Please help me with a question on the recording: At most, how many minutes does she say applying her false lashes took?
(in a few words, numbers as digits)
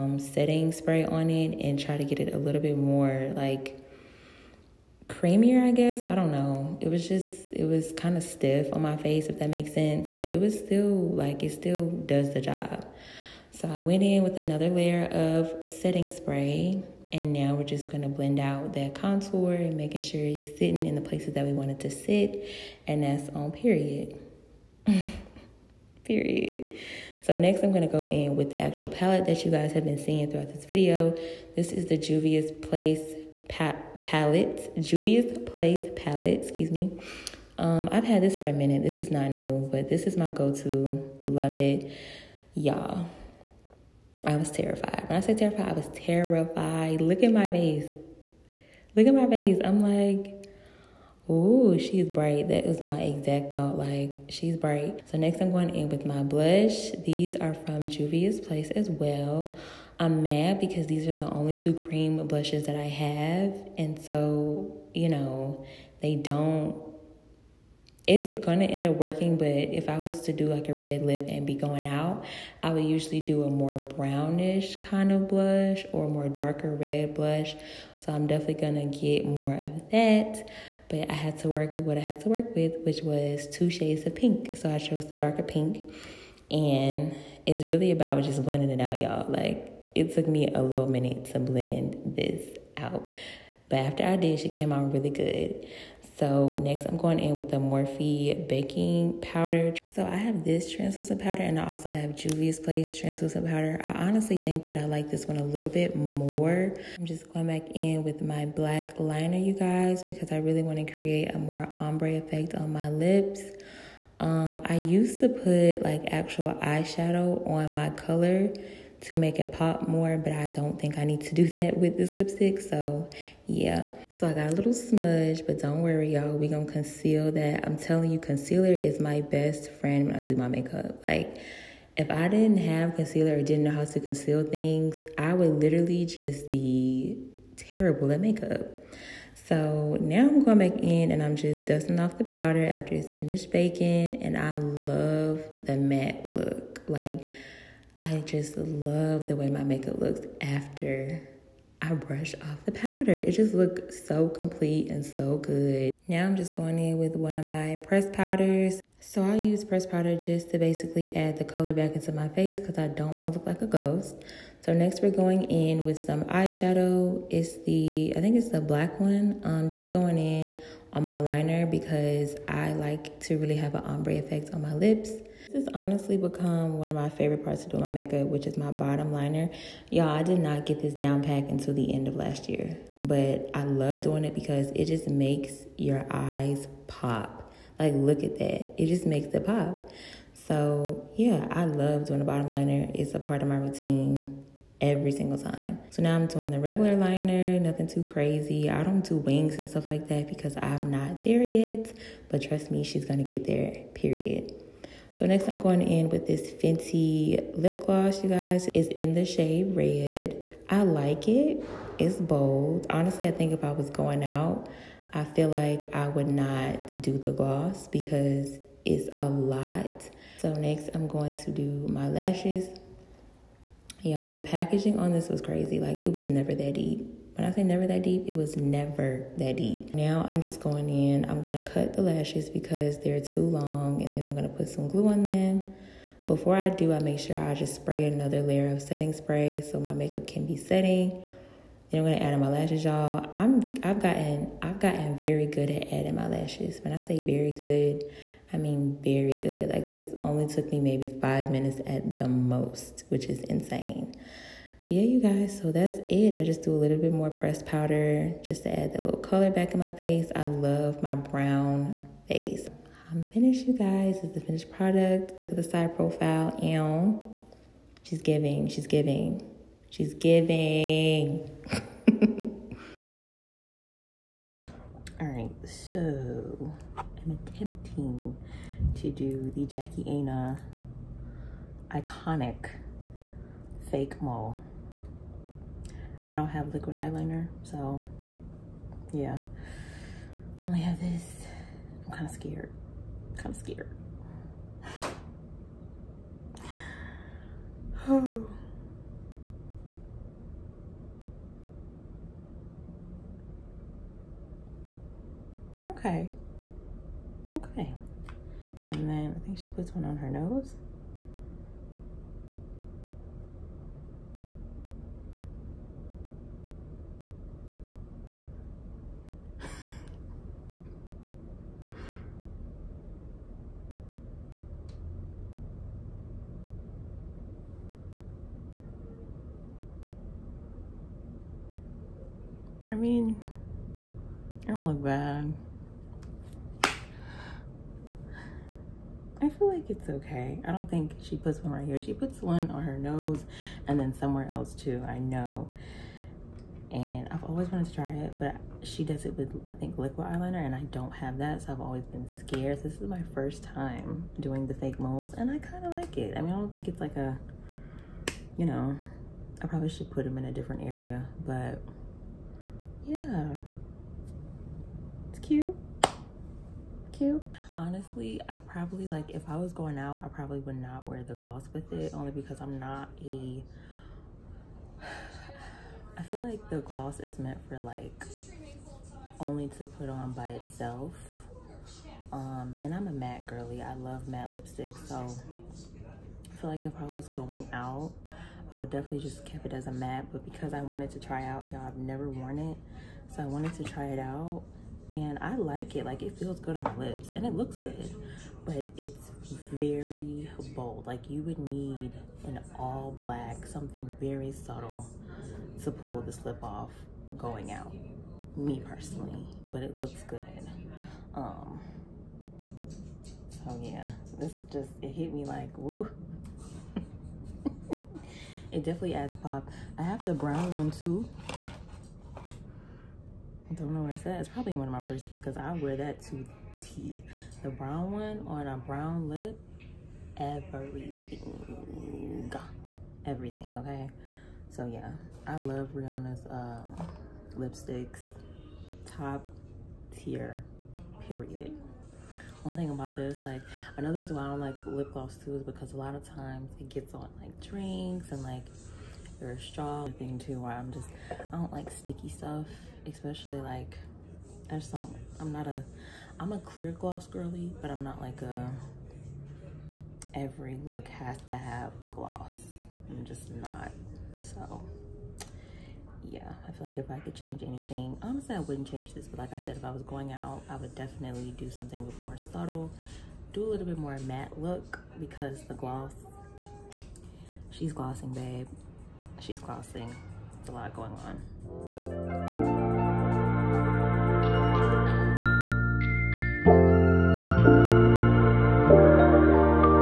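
5.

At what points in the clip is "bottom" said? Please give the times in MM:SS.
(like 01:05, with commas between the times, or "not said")
02:58, 03:12.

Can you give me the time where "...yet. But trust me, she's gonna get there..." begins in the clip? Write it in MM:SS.
03:21.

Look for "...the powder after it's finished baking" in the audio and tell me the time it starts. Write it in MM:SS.
02:22.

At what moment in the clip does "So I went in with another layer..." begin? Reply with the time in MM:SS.
00:13.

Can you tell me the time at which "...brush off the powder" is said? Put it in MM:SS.
02:31.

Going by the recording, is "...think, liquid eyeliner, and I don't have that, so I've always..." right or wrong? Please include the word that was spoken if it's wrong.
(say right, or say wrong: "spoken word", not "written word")
right.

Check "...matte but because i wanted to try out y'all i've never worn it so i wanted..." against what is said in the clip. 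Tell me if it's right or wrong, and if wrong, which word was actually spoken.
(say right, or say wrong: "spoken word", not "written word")
right.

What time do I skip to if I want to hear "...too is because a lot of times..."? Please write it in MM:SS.
07:25.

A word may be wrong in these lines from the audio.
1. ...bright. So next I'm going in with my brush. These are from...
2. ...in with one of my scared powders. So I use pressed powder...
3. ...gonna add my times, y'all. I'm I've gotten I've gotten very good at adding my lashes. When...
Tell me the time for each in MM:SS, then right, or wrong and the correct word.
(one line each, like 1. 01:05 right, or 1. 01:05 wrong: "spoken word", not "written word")
1. 00:54 wrong: "blush", not "brush"
2. 02:36 wrong: "pressed", not "scared"
3. 04:02 wrong: "lashes", not "times".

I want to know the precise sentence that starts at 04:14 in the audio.
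But yeah, you guys, so that's it.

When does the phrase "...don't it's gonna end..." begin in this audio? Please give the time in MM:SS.
01:06.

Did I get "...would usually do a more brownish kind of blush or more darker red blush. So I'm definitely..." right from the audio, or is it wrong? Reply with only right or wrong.
right.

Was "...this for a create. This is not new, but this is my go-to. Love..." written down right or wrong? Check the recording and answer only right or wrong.
wrong.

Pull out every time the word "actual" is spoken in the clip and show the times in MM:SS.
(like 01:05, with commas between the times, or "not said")
00:28, 01:56.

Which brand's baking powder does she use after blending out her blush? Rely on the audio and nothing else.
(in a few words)
Morphe.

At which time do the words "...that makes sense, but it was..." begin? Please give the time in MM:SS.
00:09.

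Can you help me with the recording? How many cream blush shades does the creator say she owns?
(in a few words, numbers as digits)
2.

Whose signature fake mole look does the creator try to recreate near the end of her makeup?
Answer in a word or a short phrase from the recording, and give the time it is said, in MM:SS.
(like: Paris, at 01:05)
Jackie Aina, at 04:39.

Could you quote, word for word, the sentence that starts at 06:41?
Like you would need an all black, something very subtle to pull this lip off going out.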